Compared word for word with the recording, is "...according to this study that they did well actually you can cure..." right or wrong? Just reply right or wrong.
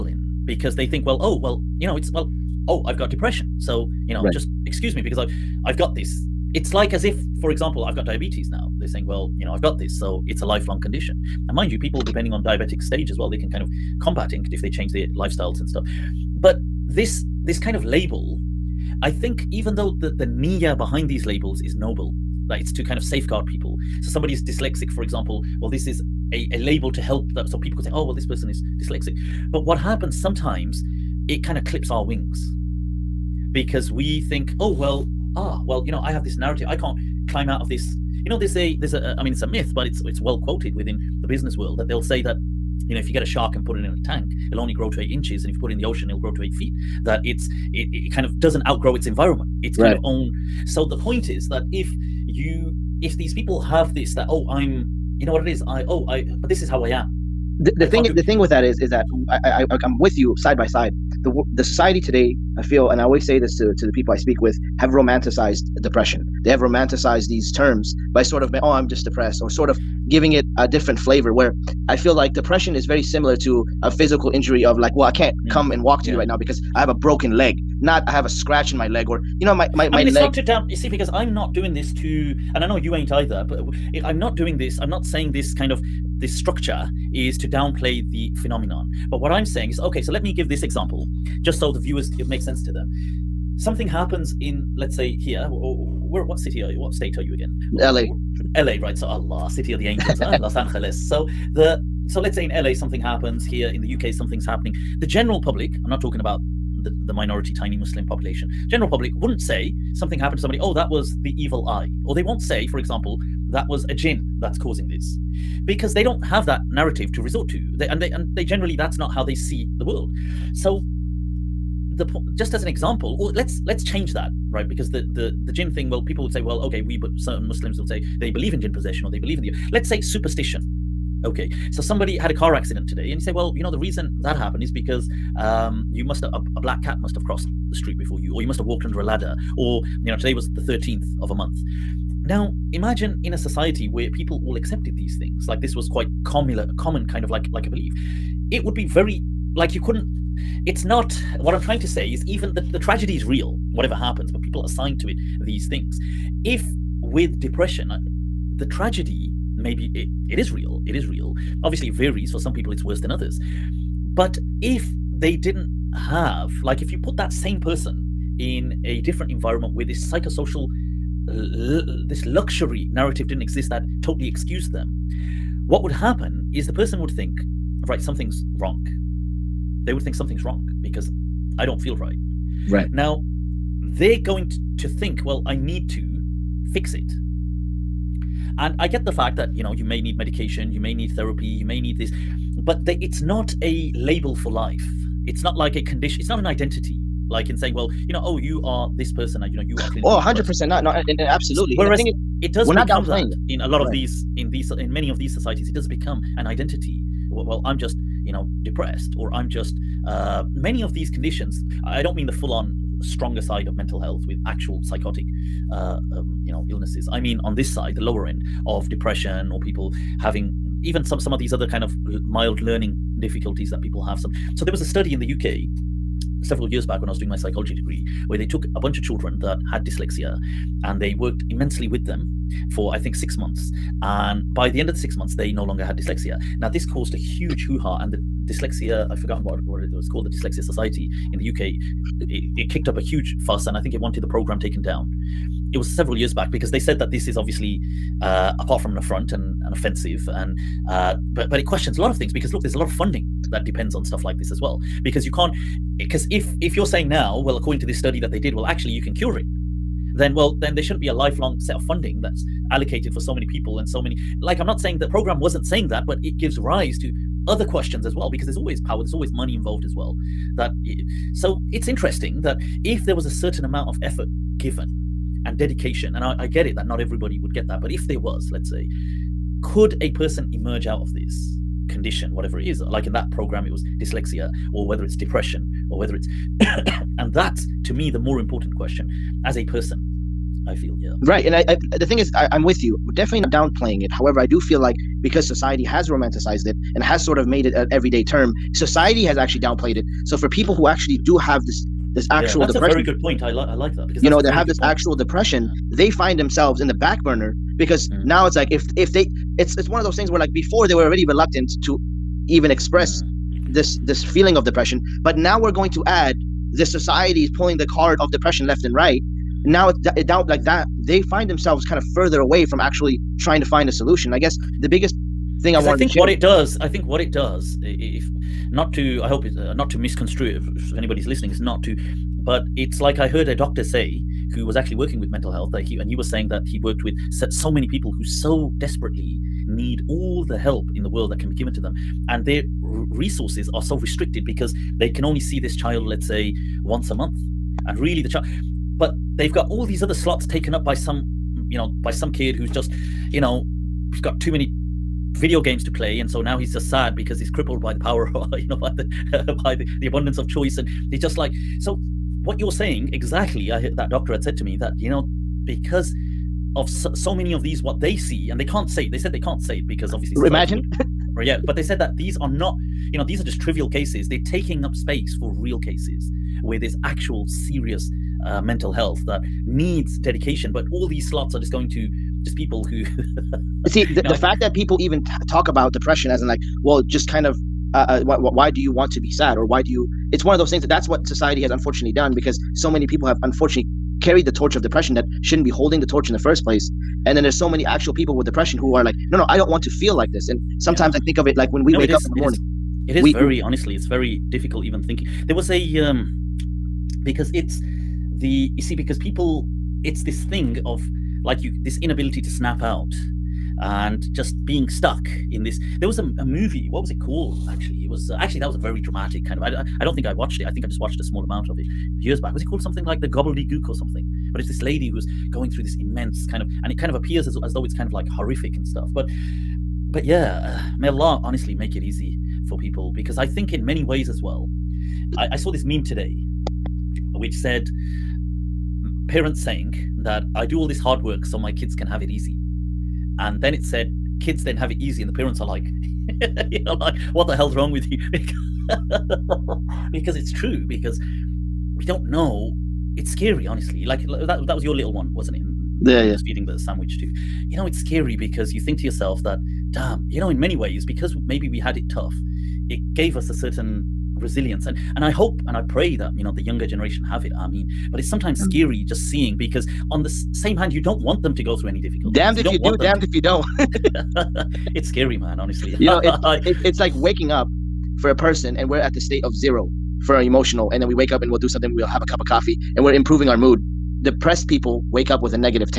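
right.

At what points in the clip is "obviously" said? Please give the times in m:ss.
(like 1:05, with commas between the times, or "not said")
2:41, 4:07, 6:10.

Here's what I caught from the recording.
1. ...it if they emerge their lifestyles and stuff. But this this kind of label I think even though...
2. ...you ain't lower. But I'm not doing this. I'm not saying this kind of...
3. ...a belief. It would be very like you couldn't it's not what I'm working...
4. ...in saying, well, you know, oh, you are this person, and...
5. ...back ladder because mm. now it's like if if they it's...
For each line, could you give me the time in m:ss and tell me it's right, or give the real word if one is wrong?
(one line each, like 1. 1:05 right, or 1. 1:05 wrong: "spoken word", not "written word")
1. 0:14 wrong: "change", not "emerge"
2. 1:22 wrong: "either", not "lower"
3. 2:27 wrong: "trying", not "working"
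4. 3:17 right
5. 5:06 wrong: "burner", not "ladder".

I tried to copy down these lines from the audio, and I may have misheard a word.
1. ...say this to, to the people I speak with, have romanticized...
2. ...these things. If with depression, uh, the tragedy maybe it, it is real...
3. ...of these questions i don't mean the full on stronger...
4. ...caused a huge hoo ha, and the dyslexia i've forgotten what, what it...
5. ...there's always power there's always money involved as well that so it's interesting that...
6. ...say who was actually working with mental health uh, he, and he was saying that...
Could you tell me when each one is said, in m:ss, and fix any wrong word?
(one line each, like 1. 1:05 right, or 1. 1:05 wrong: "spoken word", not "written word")
1. 1:03 right
2. 2:35 right
3. 3:30 wrong: "conditions", not "questions"
4. 3:56 right
5. 4:28 right
6. 5:33 right.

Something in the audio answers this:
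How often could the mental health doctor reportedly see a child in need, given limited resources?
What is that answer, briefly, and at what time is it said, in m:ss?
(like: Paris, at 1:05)
once a month, at 5:46.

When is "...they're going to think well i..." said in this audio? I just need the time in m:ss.
3:03.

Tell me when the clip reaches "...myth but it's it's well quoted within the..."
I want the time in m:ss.
0:39.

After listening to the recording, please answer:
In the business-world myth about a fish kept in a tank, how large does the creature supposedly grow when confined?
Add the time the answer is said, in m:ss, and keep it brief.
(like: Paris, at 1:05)
8 inches, at 0:44.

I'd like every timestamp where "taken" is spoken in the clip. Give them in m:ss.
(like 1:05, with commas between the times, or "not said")
4:04, 5:50.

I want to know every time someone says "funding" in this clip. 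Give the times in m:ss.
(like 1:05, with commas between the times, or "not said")
4:12, 4:21.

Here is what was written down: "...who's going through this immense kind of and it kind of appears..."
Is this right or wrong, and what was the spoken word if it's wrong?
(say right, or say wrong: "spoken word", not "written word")
right.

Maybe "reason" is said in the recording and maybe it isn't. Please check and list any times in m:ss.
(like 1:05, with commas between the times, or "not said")
2:13.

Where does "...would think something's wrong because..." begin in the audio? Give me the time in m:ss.
2:59.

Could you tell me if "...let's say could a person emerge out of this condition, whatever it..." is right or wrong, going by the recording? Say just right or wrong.
right.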